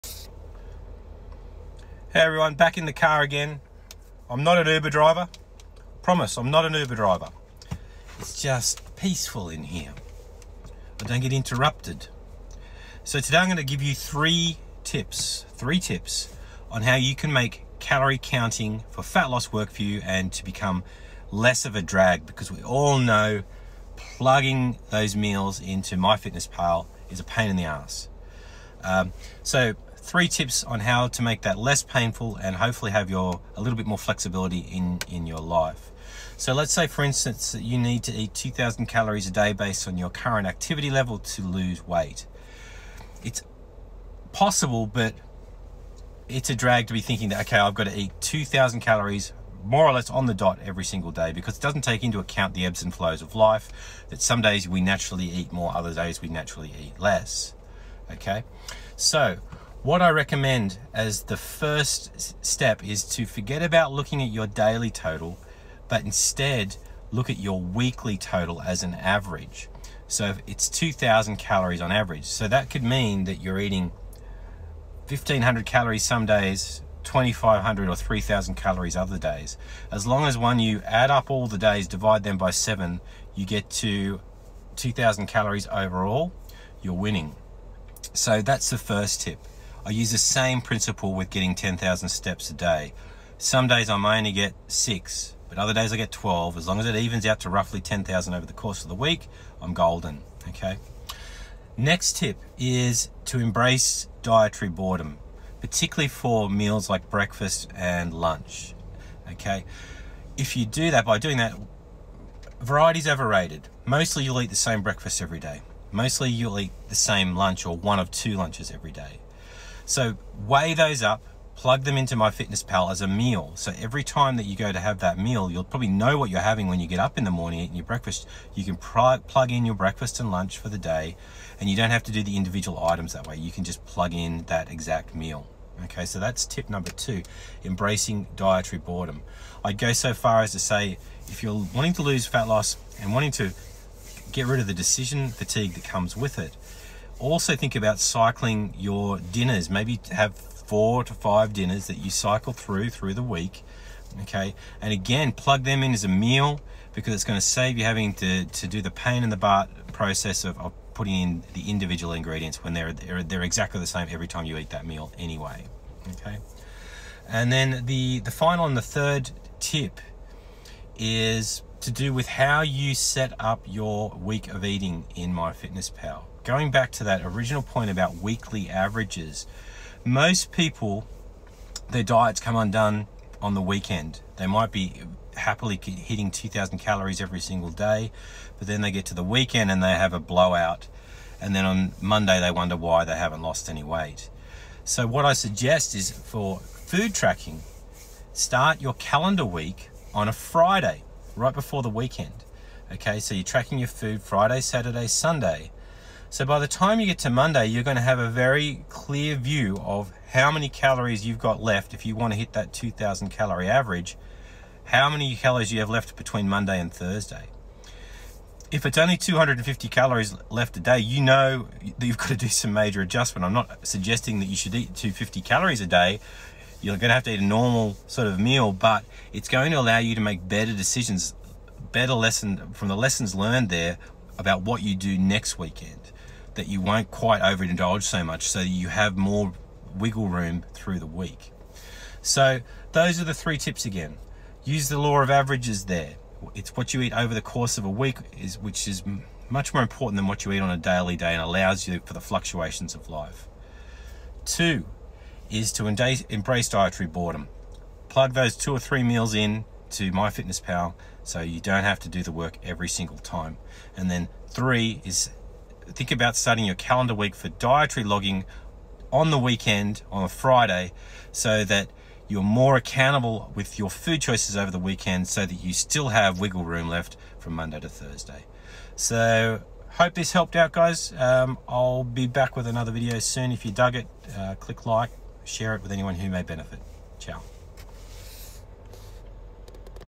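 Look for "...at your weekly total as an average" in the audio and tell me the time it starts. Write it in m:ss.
1:07.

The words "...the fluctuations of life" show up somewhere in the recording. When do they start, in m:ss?
4:12.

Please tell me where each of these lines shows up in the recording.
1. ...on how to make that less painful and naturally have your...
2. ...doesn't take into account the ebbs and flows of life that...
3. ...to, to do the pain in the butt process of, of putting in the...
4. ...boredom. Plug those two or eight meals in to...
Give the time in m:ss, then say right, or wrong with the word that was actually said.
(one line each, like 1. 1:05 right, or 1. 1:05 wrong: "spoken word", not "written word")
1. 0:30 wrong: "hopefully", not "naturally"
2. 0:51 right
3. 2:38 right
4. 4:17 wrong: "three", not "eight".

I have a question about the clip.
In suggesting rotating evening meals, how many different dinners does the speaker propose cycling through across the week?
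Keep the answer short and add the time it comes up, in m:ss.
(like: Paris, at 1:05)
4 to 5, at 2:30.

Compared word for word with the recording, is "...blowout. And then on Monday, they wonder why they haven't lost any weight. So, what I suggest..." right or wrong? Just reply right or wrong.
right.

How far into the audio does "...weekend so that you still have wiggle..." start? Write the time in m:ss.
4:34.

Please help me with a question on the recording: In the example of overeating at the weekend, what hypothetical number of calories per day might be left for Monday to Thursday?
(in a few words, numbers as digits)
250.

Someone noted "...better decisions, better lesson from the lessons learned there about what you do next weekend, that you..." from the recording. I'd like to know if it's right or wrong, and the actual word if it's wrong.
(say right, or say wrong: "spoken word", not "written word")
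right.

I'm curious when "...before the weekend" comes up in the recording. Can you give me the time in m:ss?
3:21.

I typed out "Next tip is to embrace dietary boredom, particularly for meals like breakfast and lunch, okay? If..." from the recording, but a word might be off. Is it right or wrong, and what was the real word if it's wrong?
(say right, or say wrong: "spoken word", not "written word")
right.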